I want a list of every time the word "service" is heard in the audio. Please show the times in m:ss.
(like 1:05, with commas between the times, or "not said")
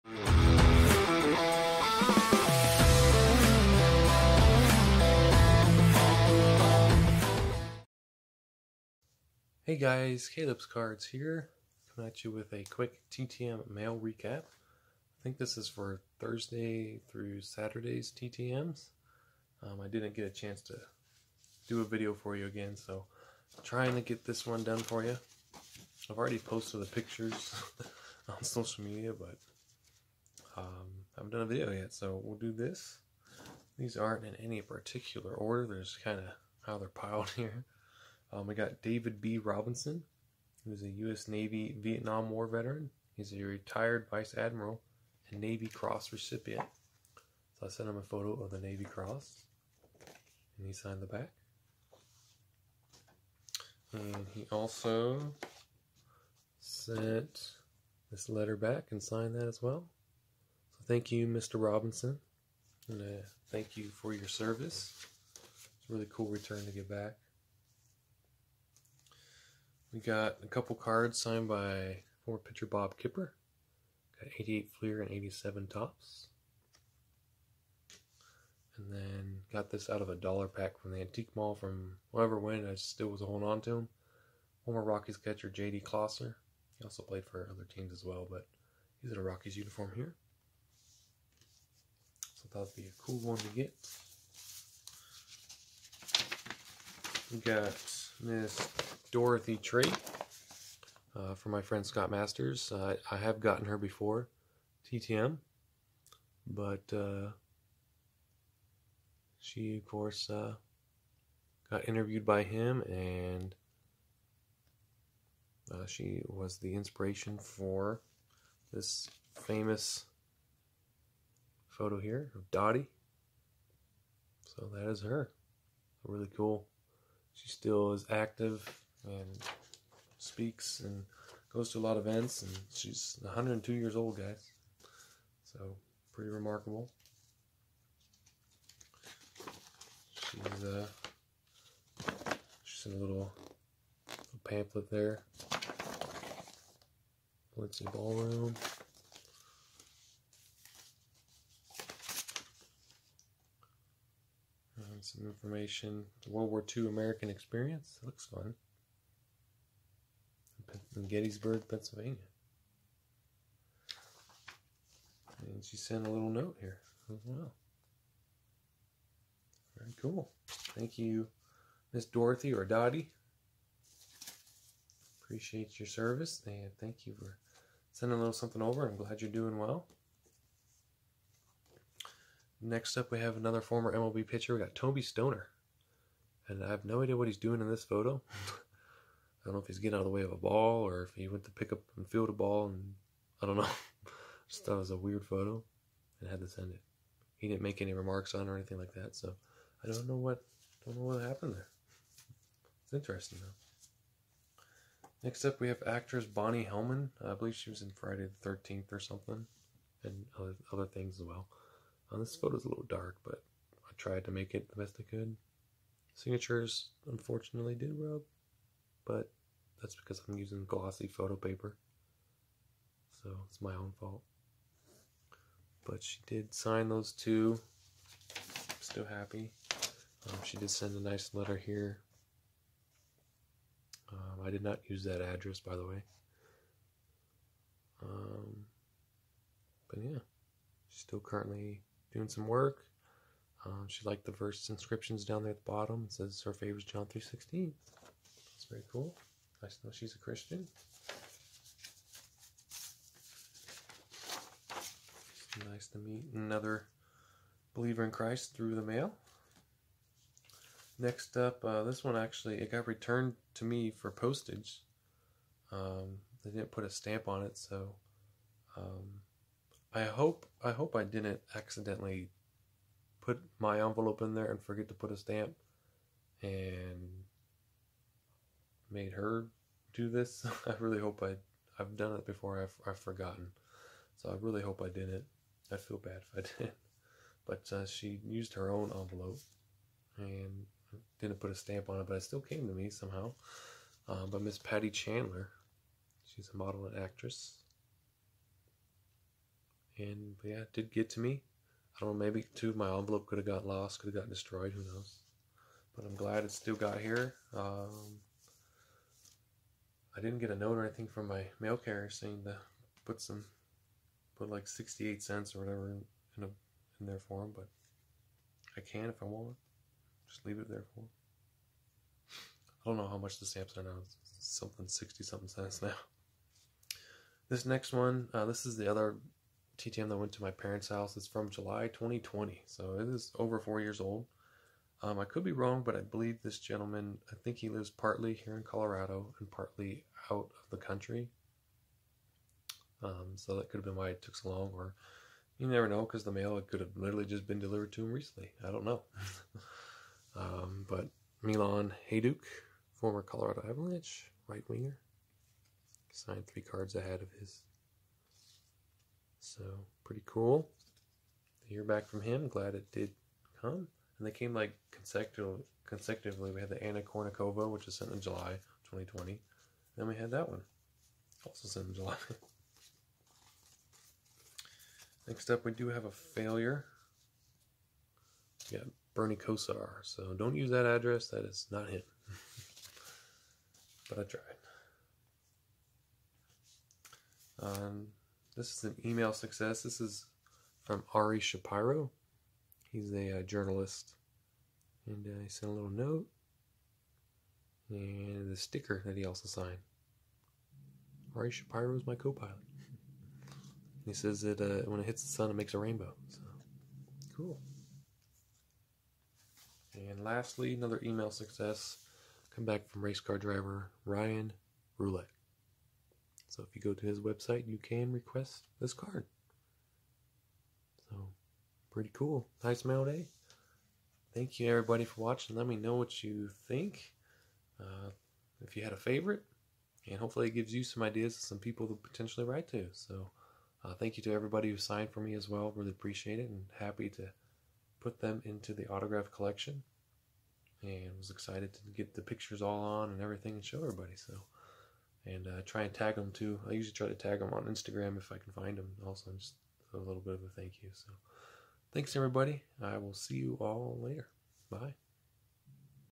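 1:04, 2:55.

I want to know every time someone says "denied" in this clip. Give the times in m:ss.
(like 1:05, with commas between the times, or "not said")
not said.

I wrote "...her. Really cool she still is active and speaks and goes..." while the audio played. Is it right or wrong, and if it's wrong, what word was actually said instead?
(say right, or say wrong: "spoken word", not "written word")
right.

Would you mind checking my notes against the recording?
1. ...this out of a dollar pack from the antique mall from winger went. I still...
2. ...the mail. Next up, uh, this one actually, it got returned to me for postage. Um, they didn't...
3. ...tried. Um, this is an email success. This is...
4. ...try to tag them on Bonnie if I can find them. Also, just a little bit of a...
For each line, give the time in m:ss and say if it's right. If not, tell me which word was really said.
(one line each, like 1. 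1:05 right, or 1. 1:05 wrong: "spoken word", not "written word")
1. 1:19 wrong: "whoever", not "winger"
2. 4:18 right
3. 6:24 right
4. 7:26 wrong: "Instagram", not "Bonnie".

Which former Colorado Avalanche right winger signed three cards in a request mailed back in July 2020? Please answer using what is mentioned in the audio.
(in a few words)
Milan Hejduk.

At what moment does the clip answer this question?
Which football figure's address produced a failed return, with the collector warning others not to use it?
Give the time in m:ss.
6:19.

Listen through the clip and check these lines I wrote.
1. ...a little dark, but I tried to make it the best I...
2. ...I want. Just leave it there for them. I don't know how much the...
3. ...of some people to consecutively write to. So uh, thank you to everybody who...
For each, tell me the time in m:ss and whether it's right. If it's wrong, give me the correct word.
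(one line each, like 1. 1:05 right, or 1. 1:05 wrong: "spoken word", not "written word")
1. 3:32 right
2. 5:19 right
3. 7:11 wrong: "potentially", not "consecutively".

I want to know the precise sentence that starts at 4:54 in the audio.
Uh, by Miss Patti Chandler, she's a model and actress and yeah, it did get to me.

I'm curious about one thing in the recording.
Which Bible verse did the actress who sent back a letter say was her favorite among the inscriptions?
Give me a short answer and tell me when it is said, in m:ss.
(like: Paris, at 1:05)
John 3:16, at 4:06.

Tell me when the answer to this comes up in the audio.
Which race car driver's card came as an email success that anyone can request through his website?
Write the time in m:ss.
6:54.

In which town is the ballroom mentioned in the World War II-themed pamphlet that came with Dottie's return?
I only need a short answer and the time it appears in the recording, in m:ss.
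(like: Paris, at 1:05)
Gettysburg, at 2:41.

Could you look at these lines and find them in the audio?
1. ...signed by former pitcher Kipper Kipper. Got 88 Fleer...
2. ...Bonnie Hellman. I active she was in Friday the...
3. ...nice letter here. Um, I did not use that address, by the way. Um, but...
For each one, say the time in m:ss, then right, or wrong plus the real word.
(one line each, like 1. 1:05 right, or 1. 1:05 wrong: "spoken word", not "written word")
1. 1:11 wrong: "Bob", not "Kipper"
2. 3:26 wrong: "believe", not "active"
3. 3:51 right.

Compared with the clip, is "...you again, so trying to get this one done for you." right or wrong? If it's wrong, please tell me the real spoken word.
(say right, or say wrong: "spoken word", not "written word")
right.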